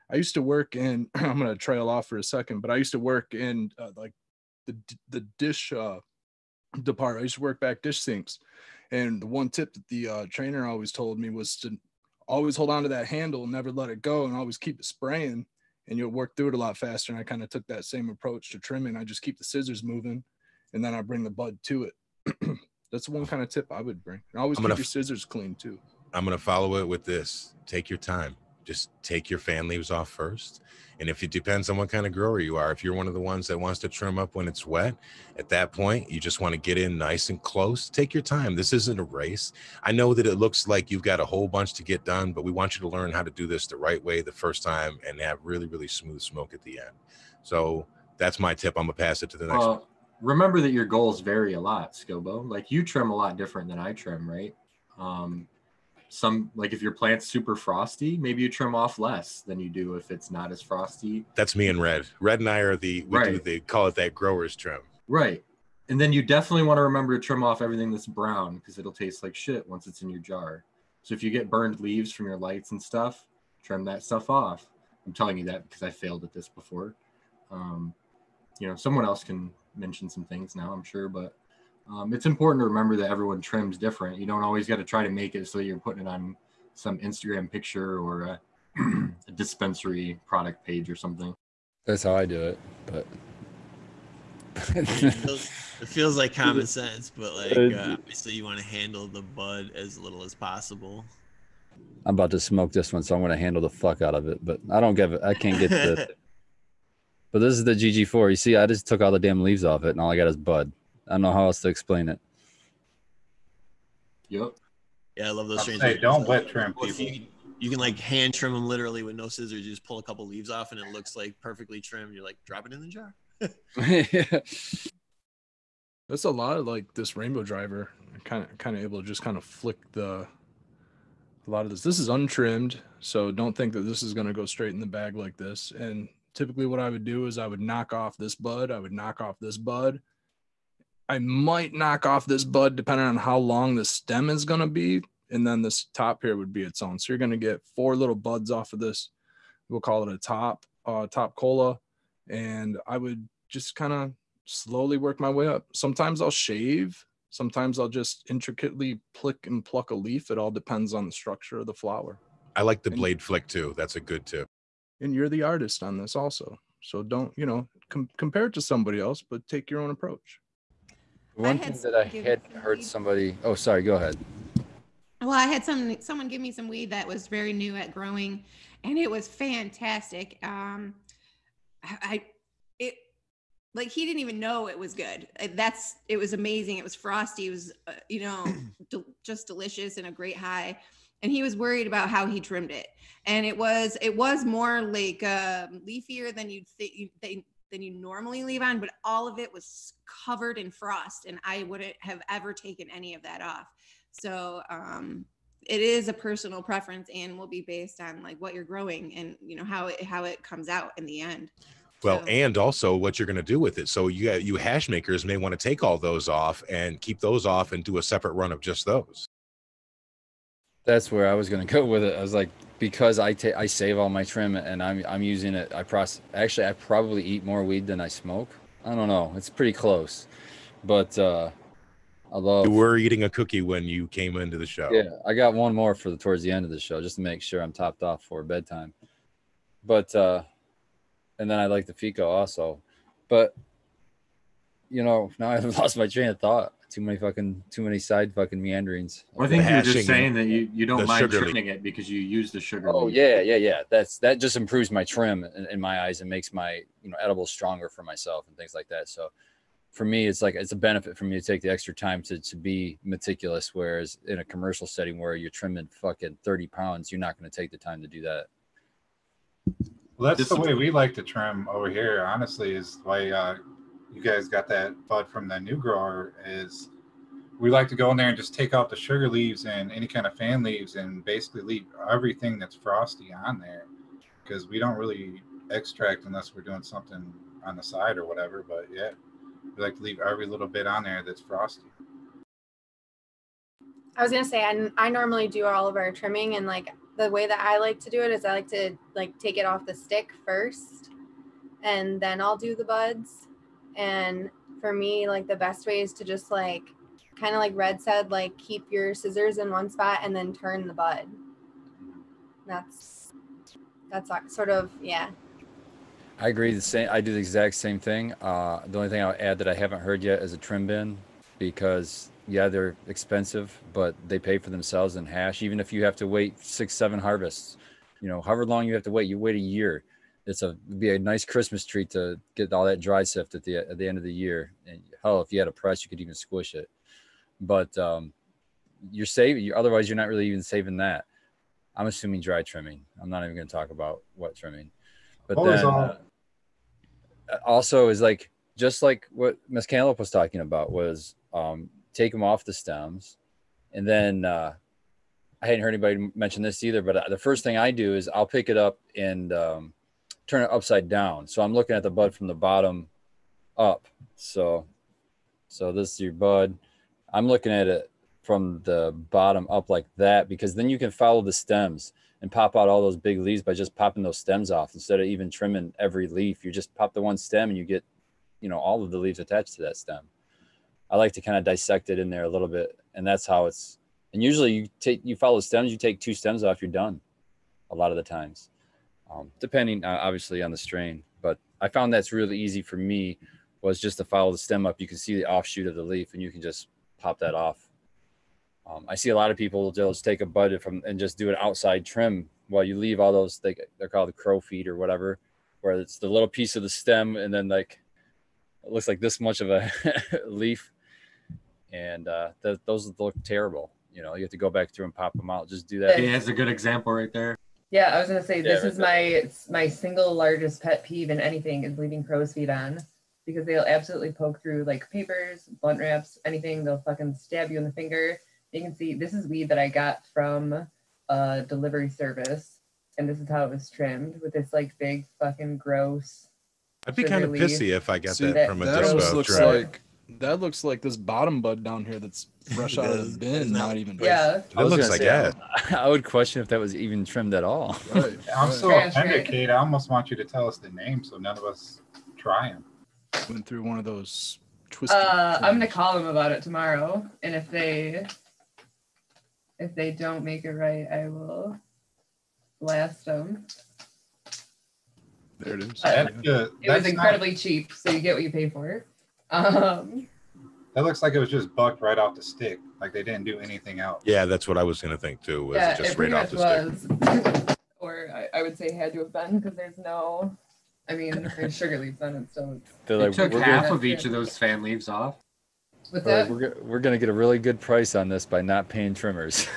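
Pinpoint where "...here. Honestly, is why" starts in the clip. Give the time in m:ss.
4:31.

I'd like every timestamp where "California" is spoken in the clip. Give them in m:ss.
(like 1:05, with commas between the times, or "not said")
not said.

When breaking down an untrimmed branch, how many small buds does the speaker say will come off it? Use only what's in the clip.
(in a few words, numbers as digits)
4.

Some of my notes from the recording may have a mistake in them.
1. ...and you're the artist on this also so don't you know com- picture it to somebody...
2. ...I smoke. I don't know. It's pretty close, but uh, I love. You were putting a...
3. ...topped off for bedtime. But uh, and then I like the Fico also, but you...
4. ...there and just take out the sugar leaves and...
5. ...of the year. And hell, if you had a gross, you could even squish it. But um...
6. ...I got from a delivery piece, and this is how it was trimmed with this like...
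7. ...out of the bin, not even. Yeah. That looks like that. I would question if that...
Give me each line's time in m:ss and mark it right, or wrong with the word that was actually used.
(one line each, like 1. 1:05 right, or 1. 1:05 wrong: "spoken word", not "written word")
1. 2:45 wrong: "compare", not "picture"
2. 3:48 wrong: "eating", not "putting"
3. 3:57 right
4. 4:38 right
5. 5:34 wrong: "press", not "gross"
6. 7:09 wrong: "service", not "piece"
7. 7:22 right.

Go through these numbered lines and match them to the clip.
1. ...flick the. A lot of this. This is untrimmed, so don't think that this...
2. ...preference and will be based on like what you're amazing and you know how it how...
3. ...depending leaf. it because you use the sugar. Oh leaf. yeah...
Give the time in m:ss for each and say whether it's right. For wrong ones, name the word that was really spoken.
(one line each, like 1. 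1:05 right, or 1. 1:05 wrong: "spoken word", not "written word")
1. 2:09 right
2. 3:26 wrong: "growing", not "amazing"
3. 4:11 wrong: "trimming", not "depending".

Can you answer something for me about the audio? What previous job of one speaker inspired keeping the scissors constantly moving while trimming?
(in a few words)
Dish sinks.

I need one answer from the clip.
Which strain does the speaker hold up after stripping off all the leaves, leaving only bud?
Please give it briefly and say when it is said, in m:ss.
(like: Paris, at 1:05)
GG4, at 1:47.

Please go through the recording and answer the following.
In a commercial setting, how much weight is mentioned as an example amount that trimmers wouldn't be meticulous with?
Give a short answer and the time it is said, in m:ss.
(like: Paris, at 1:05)
30 pounds, at 4:26.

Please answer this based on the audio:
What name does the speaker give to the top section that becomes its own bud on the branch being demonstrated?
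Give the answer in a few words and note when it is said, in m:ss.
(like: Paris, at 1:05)
Top cola, at 2:31.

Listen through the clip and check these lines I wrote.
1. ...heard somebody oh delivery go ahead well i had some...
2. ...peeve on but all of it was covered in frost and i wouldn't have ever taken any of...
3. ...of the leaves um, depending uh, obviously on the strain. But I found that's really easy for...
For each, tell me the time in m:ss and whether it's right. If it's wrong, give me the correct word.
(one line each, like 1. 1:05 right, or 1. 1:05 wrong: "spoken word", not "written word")
1. 2:52 wrong: "sorry", not "delivery"
2. 3:18 wrong: "leave", not "peeve"
3. 6:28 wrong: "times", not "leaves".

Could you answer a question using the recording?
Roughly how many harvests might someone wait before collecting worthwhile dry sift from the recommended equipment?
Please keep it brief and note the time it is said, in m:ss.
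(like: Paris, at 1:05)
6 or 7, at 5:26.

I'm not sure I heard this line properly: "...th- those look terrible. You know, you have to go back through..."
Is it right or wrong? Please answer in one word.
right.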